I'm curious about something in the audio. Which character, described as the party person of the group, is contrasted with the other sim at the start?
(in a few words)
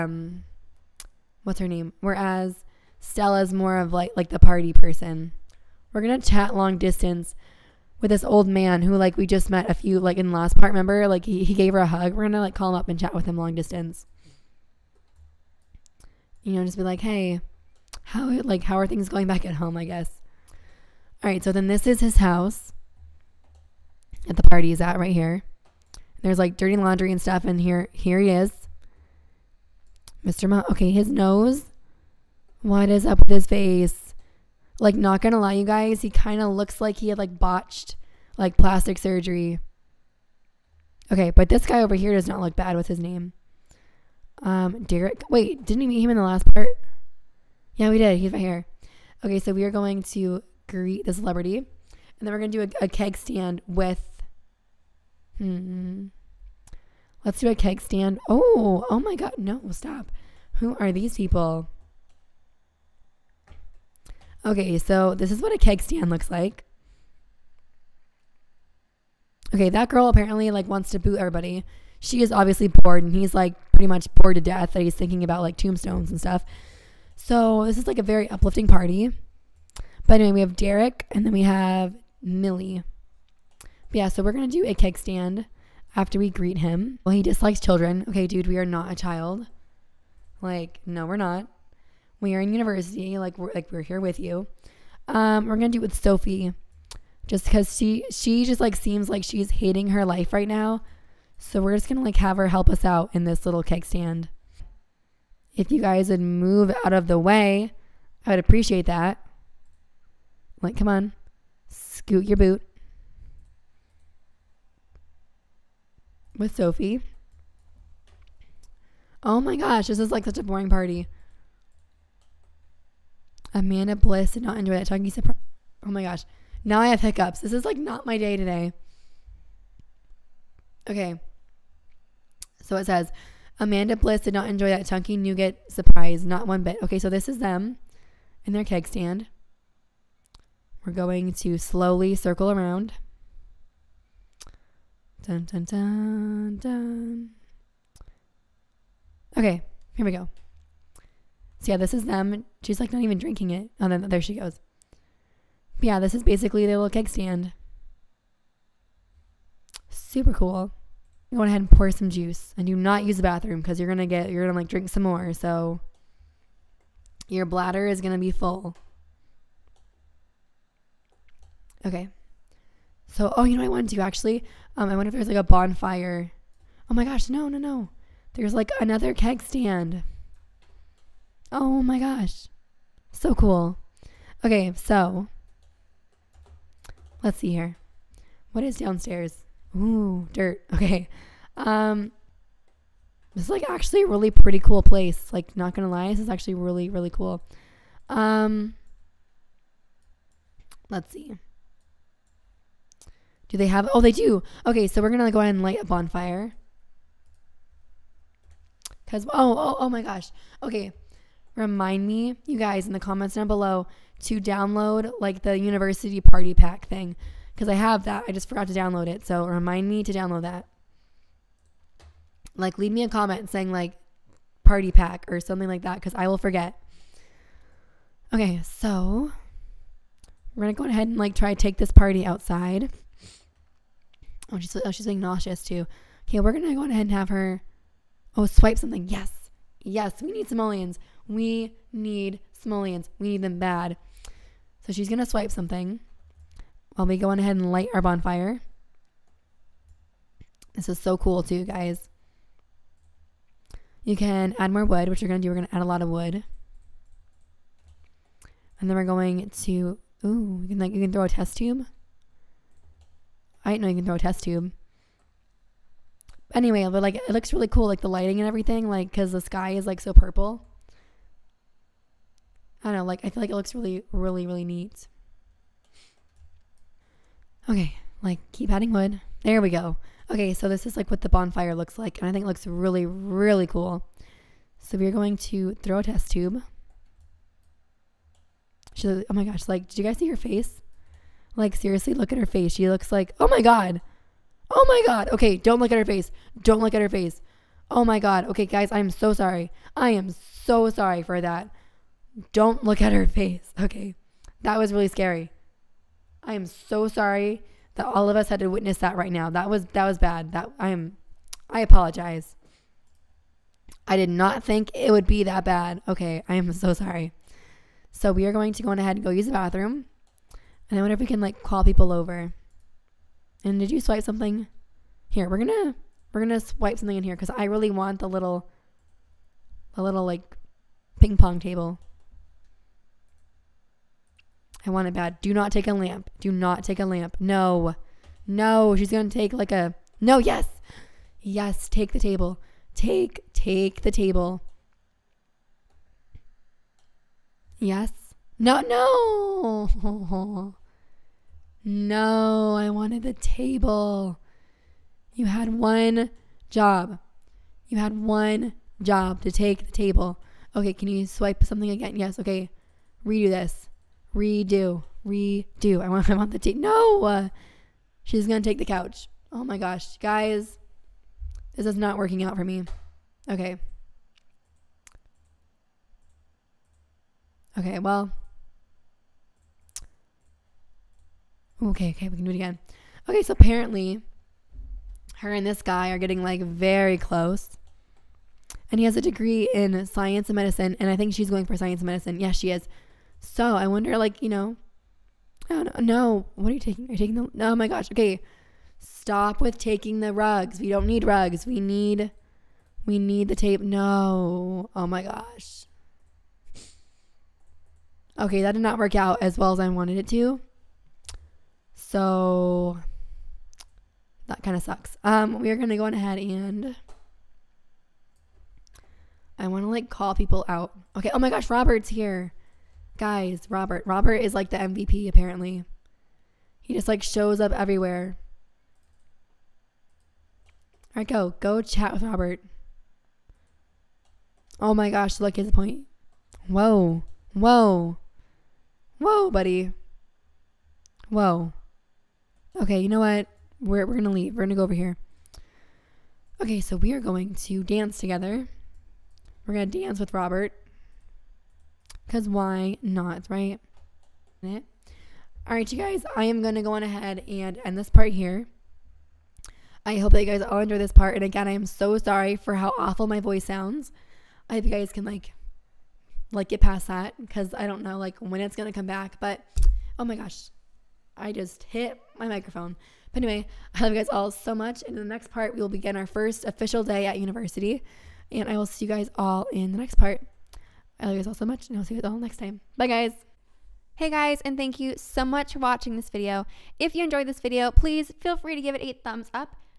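Stella.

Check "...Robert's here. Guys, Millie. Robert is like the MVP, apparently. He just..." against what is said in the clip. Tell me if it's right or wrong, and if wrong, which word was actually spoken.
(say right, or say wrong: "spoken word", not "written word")
wrong: "Robert", not "Millie".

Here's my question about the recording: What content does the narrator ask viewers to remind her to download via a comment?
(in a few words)
university party pack.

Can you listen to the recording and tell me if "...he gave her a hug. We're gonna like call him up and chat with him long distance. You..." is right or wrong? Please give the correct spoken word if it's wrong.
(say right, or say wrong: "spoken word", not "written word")
right.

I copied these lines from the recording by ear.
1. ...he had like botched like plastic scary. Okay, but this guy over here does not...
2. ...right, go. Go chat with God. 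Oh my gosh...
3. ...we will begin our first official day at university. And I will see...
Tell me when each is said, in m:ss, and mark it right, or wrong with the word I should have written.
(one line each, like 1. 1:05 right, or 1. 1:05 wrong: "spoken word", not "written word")
1. 0:36 wrong: "surgery", not "scary"
2. 7:11 wrong: "Robert", not "God"
3. 7:55 right.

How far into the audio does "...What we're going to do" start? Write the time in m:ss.
4:15.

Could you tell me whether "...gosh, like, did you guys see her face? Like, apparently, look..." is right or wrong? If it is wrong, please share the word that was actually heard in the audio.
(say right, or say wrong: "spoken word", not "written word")
wrong: "seriously", not "apparently".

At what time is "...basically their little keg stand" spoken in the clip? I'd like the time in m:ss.
2:36.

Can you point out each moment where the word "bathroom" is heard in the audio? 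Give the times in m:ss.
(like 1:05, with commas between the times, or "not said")
2:43, 5:19.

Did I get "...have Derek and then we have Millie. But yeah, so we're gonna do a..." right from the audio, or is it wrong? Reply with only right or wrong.
right.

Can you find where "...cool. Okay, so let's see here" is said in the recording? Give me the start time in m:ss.
3:03.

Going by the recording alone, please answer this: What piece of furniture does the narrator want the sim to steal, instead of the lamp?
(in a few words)
ping pong table.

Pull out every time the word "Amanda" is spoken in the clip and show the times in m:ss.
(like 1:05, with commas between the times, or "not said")
2:03, 2:13.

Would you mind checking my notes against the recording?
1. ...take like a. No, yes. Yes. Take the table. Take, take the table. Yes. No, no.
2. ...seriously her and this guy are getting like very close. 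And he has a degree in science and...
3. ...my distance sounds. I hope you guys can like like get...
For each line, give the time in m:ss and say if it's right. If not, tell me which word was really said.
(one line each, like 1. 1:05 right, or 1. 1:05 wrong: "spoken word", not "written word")
1. 5:39 right
2. 6:23 wrong: "apparently", not "seriously"
3. 7:43 wrong: "voice", not "distance".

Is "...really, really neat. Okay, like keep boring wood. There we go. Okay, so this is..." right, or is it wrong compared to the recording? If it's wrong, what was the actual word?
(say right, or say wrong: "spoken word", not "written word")
wrong: "adding", not "boring".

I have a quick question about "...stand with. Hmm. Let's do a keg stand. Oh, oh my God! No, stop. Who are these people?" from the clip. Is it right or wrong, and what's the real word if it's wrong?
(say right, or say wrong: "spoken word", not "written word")
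right.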